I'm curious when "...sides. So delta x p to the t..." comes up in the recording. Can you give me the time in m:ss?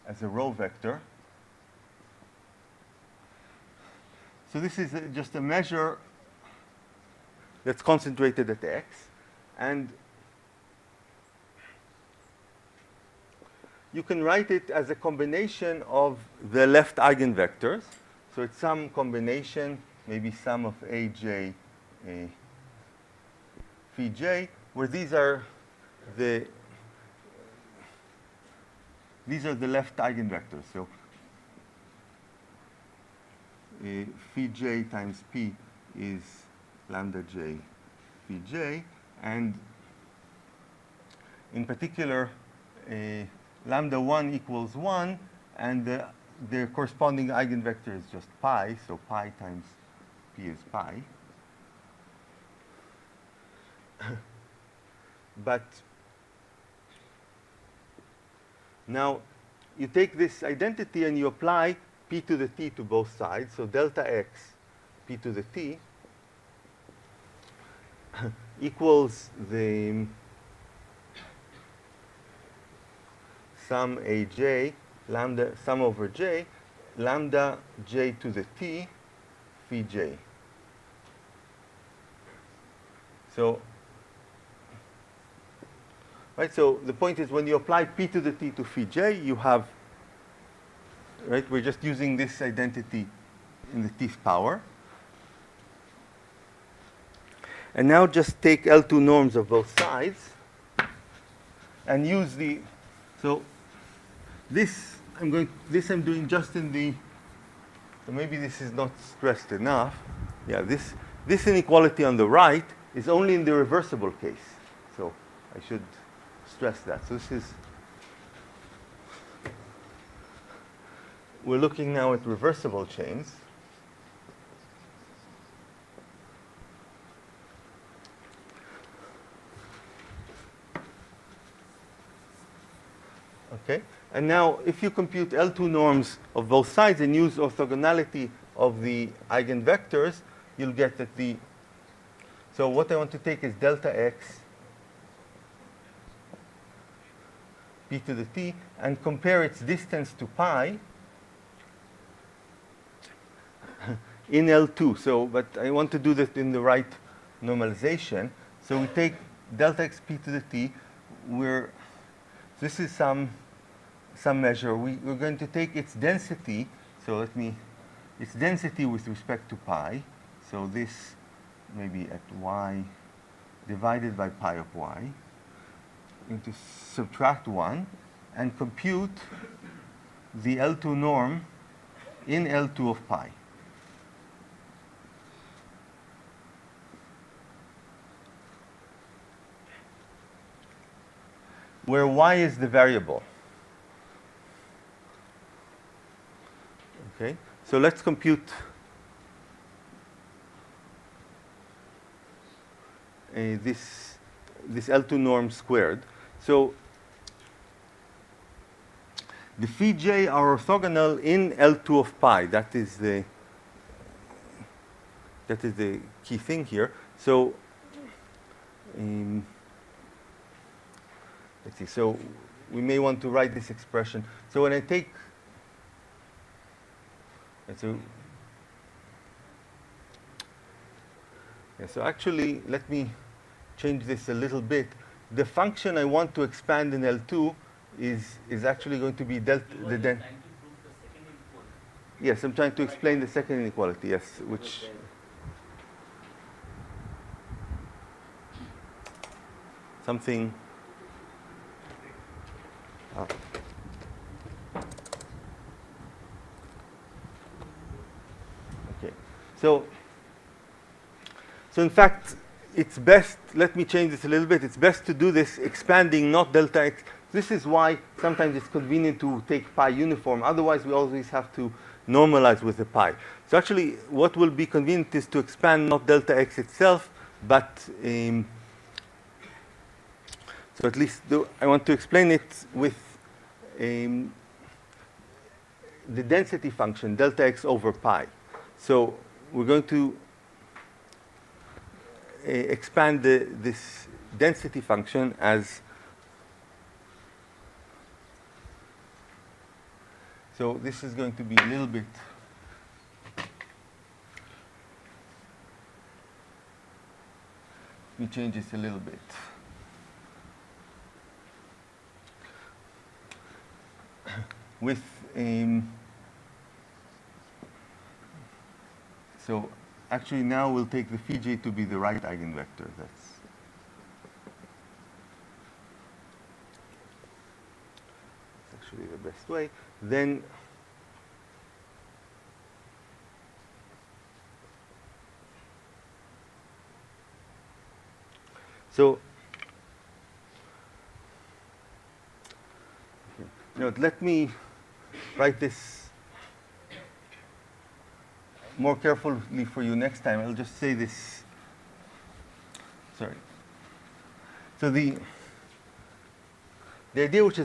1:03.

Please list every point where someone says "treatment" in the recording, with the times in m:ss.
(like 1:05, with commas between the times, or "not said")
not said.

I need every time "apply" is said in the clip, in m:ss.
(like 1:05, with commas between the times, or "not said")
1:01, 1:27.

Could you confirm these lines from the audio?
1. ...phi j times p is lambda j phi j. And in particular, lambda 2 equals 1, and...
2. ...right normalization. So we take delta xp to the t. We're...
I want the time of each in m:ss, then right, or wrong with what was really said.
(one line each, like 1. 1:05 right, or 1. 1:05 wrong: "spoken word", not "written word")
1. 0:34 wrong: "1", not "2"
2. 2:36 right.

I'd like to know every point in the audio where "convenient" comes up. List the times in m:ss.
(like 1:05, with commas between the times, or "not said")
4:28, 4:34.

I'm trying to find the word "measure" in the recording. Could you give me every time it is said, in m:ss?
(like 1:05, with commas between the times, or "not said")
0:05, 2:44.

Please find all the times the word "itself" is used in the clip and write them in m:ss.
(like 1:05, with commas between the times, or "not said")
4:36.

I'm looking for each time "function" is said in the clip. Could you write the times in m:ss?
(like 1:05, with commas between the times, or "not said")
3:55, 4:46, 4:54.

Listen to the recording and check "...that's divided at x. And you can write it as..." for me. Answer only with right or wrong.
wrong.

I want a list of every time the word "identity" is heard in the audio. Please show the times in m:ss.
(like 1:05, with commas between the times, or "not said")
1:00, 1:32.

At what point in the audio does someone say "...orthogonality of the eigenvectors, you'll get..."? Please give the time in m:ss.
2:17.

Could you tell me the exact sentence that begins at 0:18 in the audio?
So it's some combination, maybe sum of aj, uh, phi j, where these are the these are the left eigenvectors.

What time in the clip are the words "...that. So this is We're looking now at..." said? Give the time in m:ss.
1:56.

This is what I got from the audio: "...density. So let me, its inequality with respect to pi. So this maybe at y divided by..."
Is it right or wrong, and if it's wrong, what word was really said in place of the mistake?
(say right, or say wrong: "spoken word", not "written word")
wrong: "density", not "inequality".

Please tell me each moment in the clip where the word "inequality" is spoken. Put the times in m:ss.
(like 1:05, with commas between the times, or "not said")
1:51, 4:03.